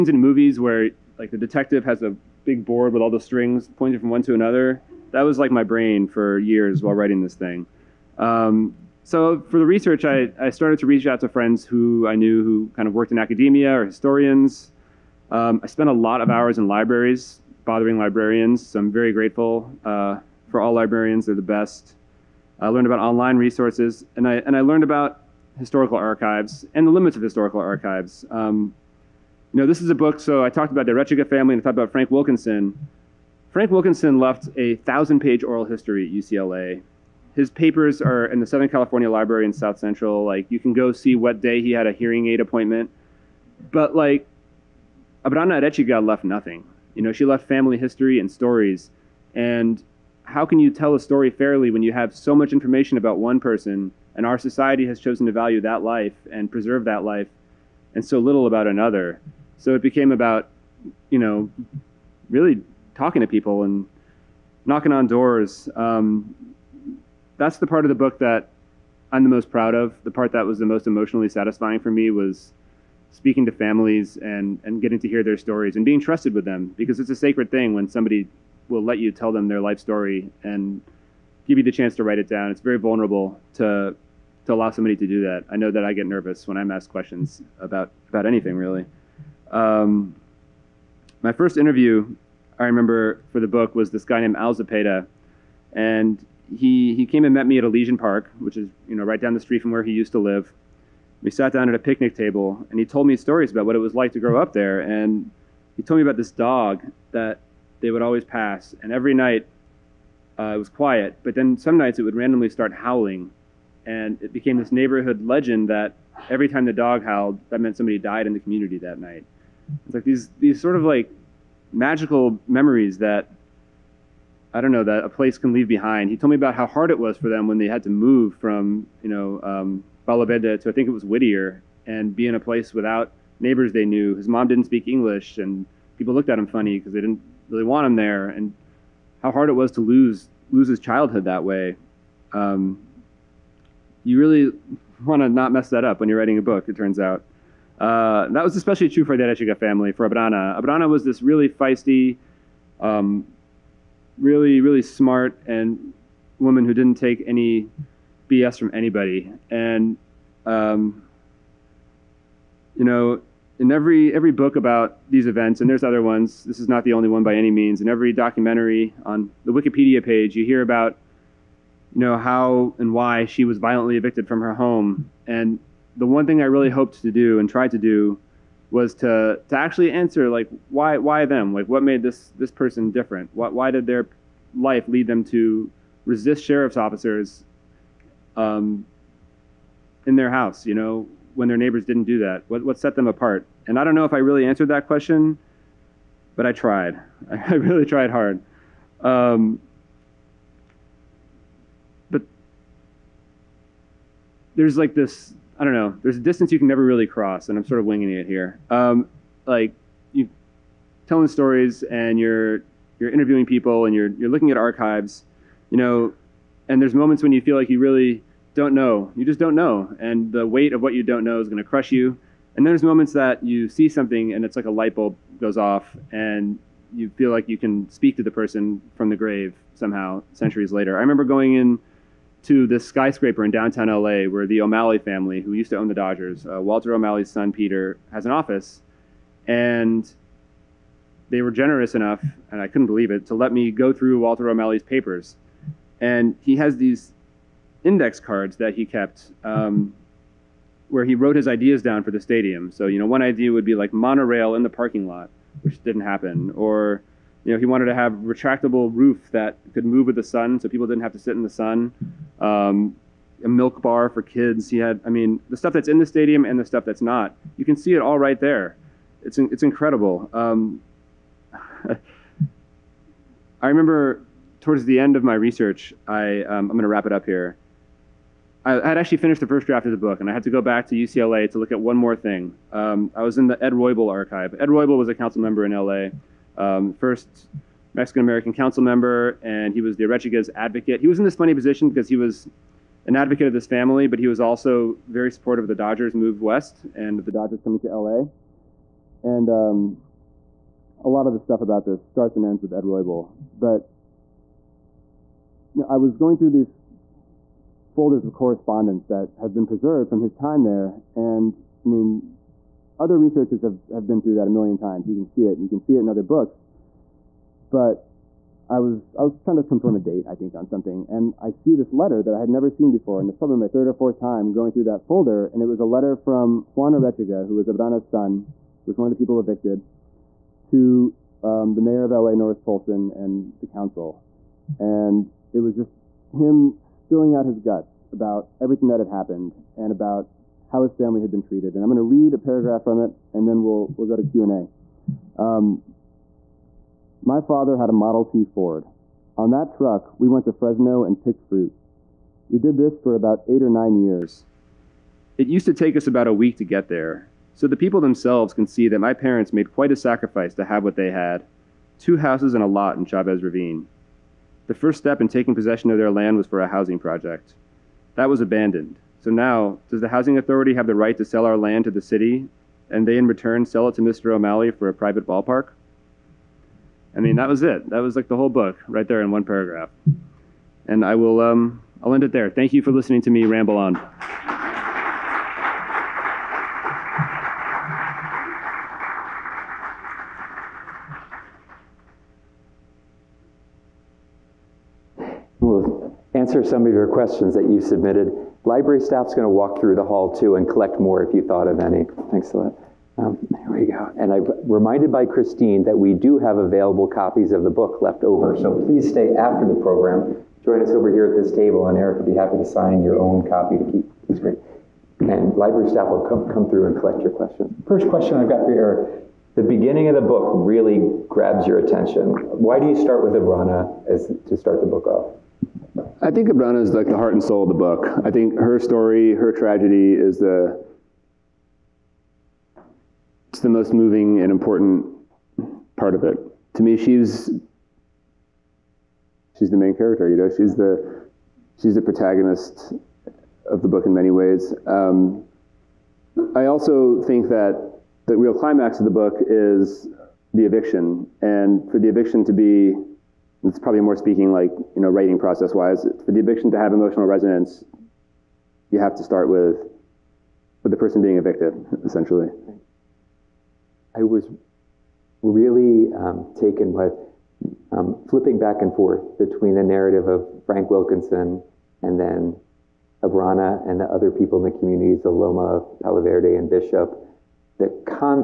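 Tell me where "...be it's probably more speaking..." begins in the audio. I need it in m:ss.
7:32.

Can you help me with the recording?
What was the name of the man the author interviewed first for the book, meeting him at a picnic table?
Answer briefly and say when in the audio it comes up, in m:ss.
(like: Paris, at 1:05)
Al Zapeta, at 1:34.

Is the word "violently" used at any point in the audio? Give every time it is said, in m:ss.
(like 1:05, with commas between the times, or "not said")
2:53.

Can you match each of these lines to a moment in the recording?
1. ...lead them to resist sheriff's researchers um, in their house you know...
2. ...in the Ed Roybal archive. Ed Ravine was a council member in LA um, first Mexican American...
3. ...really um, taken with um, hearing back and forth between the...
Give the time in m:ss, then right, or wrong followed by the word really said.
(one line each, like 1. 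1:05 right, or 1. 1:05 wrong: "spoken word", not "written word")
1. 3:04 wrong: "officers", not "researchers"
2. 4:43 wrong: "Roybal", not "Ravine"
3. 7:45 wrong: "flipping", not "hearing".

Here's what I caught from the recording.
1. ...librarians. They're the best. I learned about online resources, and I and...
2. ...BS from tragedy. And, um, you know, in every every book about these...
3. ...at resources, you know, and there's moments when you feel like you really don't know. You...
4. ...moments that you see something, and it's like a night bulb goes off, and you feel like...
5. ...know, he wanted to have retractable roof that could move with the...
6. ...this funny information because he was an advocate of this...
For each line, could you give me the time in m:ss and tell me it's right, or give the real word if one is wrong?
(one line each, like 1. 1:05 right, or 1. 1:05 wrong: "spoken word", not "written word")
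1. 0:20 right
2. 2:38 wrong: "anybody", not "tragedy"
3. 3:34 wrong: "archives", not "resources"
4. 3:42 wrong: "light", not "night"
5. 4:17 right
6. 4:51 wrong: "position", not "information".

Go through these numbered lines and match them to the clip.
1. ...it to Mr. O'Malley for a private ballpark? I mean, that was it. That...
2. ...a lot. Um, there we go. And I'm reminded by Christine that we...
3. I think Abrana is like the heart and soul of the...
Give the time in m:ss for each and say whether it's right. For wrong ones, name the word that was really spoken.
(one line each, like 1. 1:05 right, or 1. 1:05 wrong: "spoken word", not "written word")
1. 6:13 right
2. 6:42 right
3. 7:06 right.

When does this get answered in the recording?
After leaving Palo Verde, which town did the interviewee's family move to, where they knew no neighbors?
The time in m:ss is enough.
2:11.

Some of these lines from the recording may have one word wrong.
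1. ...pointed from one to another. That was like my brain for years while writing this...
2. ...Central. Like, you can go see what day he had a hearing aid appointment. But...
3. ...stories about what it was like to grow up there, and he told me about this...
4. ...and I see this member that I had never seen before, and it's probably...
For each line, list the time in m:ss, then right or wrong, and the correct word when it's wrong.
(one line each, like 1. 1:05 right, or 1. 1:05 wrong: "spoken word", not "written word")
1. 0:03 right
2. 0:39 right
3. 1:43 right
4. 5:21 wrong: "letter", not "member".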